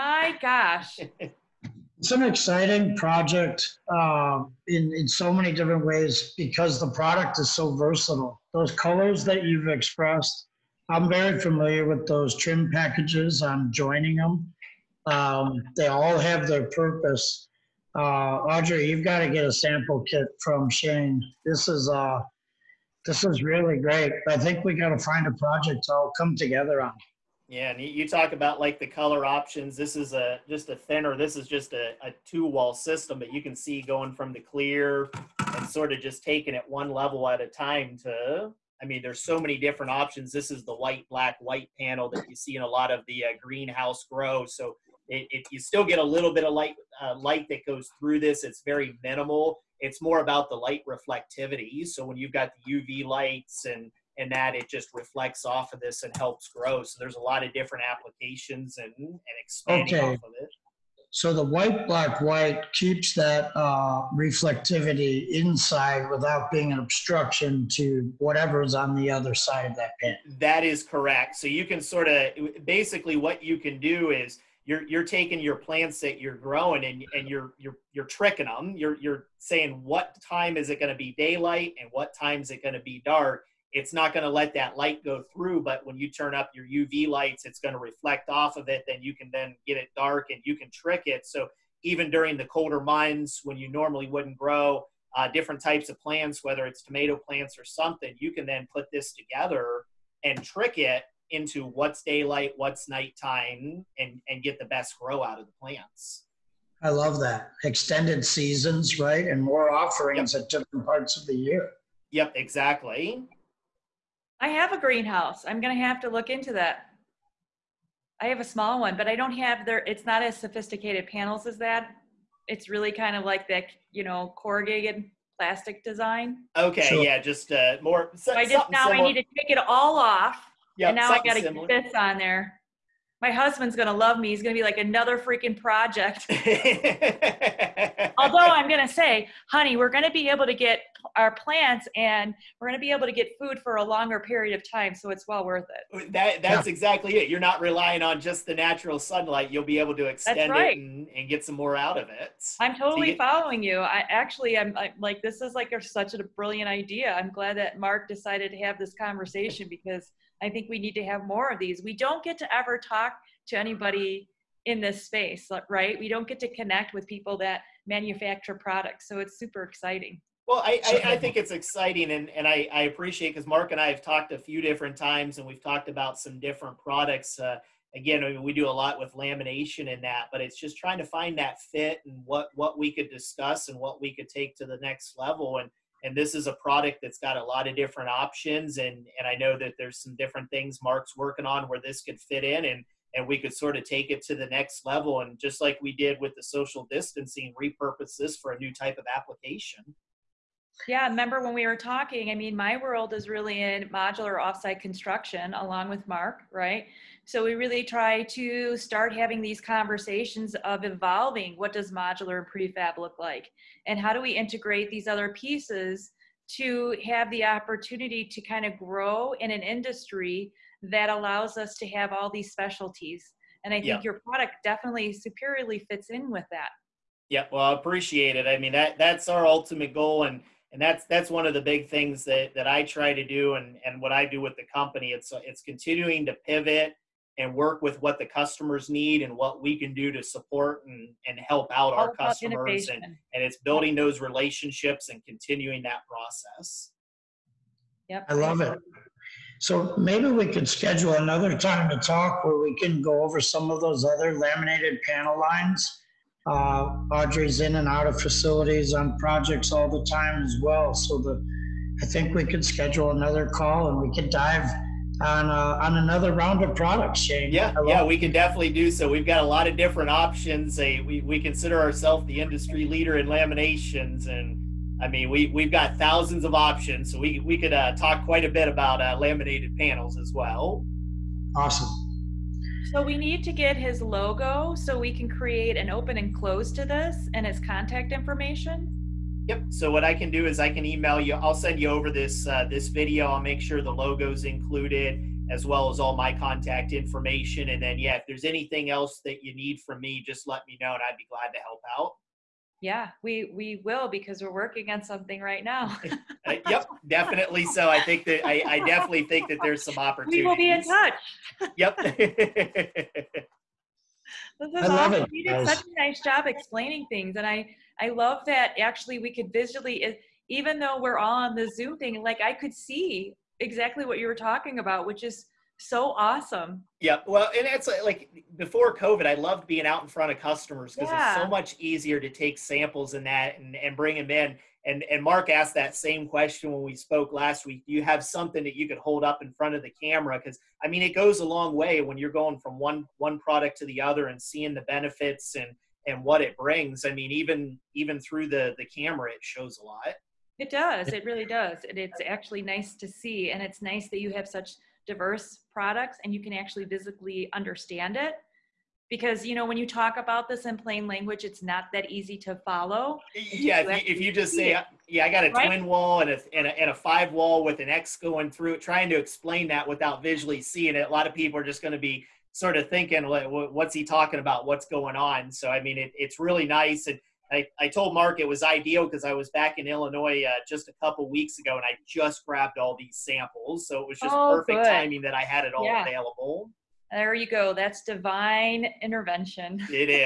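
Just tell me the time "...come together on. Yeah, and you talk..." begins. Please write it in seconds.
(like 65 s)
26 s.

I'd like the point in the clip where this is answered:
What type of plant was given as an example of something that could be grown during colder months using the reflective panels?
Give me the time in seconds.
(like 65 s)
96 s.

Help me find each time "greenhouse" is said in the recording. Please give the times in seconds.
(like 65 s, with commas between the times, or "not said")
43 s, 114 s.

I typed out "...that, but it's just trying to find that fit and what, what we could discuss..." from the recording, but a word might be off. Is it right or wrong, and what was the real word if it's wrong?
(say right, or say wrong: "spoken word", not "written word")
right.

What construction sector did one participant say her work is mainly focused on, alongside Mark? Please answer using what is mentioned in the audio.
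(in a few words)
modular offsite construction.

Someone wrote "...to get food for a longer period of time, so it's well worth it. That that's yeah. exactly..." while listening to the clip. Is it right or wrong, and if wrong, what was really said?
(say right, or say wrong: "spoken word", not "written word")
right.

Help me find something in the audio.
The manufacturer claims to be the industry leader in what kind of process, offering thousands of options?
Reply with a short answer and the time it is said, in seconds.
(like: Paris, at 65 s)
laminations, at 273 s.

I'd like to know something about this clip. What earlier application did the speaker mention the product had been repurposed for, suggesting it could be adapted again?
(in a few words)
social distancing.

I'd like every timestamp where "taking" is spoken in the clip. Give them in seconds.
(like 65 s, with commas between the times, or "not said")
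36 s, 75 s.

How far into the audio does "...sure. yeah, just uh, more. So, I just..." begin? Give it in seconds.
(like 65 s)
126 s.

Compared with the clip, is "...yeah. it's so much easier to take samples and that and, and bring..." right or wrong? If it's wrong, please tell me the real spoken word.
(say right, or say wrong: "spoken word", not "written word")
right.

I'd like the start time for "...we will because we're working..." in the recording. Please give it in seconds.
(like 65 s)
303 s.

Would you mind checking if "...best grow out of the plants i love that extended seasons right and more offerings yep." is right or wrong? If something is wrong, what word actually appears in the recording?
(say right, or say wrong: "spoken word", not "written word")
right.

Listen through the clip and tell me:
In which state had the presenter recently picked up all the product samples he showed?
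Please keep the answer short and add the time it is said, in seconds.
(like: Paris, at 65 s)
Illinois, at 379 s.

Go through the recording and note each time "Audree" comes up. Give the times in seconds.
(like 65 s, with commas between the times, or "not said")
18 s, 257 s.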